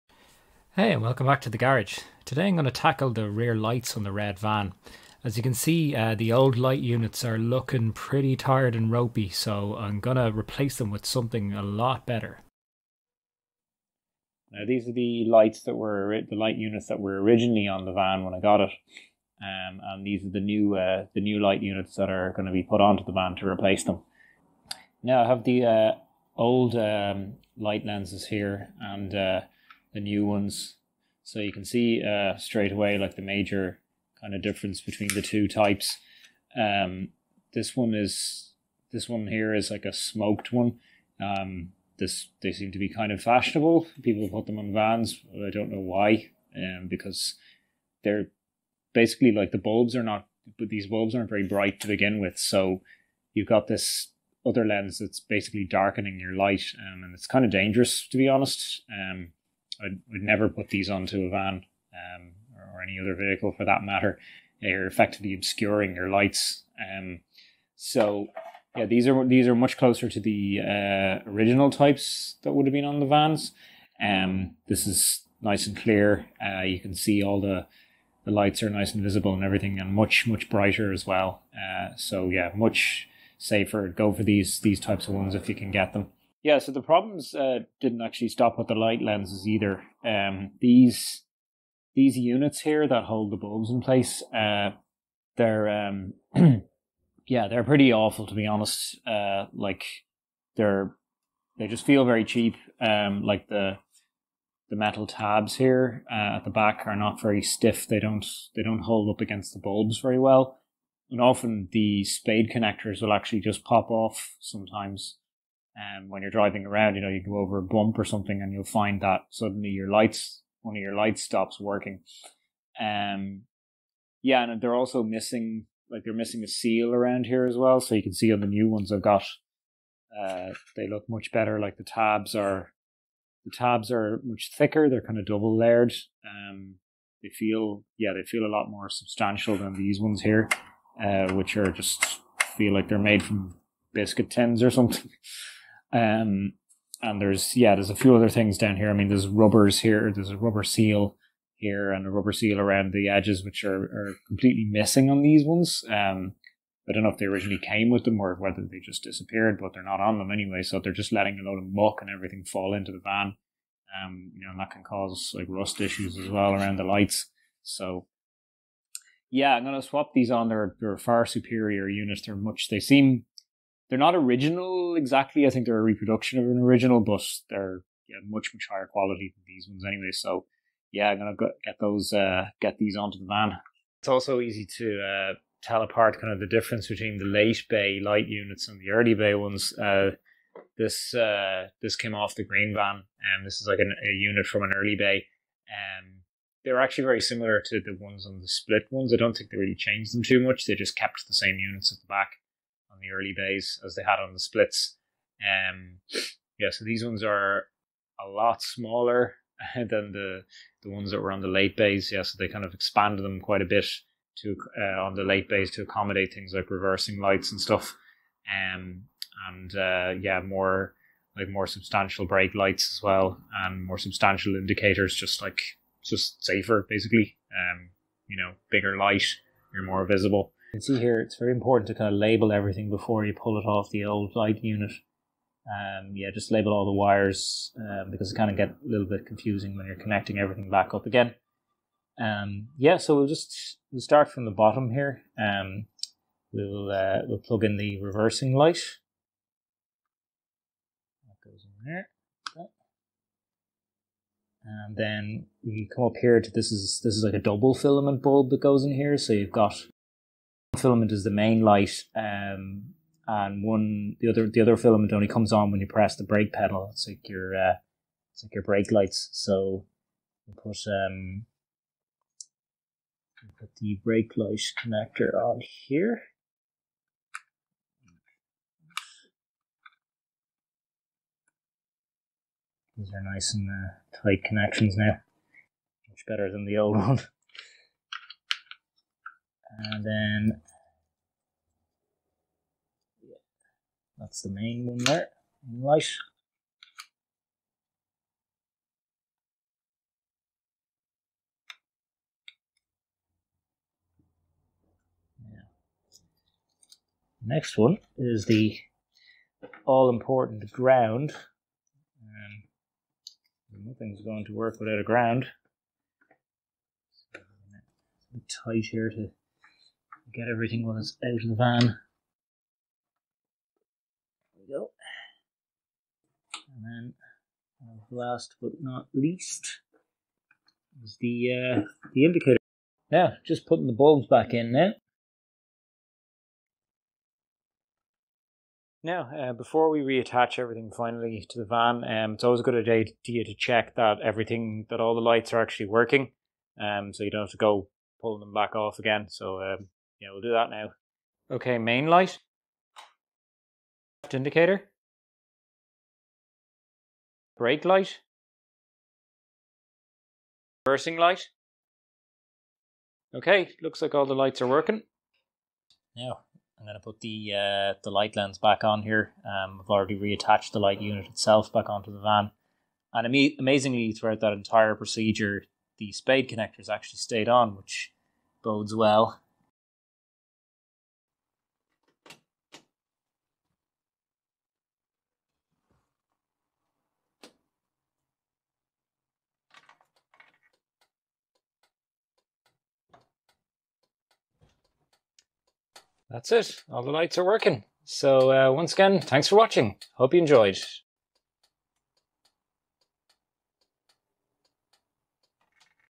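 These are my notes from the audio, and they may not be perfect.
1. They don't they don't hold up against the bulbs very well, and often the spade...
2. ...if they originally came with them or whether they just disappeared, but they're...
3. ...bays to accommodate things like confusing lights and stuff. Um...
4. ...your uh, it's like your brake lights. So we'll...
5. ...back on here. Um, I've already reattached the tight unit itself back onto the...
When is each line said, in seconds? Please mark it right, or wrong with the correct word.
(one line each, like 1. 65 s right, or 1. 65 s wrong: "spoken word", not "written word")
1. 107 s right
2. 157 s right
3. 215 s wrong: "reversing", not "confusing"
4. 267 s right
5. 368 s wrong: "light", not "tight".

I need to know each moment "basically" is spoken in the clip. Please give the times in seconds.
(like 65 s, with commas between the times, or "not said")
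48 s, 55 s, 226 s.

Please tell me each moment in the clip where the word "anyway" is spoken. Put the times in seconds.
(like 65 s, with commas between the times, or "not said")
160 s, 179 s.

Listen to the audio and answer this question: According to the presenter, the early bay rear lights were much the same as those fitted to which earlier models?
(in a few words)
The splits.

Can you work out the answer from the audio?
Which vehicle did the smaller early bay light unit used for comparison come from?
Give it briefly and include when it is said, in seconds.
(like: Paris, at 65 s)
The green van, at 192 s.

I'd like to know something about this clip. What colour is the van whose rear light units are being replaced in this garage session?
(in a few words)
Red.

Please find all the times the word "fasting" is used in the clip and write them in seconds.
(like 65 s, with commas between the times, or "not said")
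not said.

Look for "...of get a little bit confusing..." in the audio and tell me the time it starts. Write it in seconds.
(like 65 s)
238 s.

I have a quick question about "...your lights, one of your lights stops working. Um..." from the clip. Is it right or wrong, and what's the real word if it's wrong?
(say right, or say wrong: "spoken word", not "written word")
right.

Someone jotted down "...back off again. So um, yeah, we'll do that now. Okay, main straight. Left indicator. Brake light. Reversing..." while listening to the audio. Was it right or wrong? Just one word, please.
wrong.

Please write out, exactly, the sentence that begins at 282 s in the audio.
These are nice and uh, tight connections now.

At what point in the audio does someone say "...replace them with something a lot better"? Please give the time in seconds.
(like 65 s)
10 s.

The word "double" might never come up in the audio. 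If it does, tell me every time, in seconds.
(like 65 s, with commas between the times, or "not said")
135 s, 257 s.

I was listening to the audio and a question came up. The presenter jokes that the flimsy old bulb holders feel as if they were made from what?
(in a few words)
Biscuit tins.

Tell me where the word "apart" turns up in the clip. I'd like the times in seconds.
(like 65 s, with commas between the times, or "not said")
185 s.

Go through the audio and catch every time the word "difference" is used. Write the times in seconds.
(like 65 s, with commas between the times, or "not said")
34 s, 186 s.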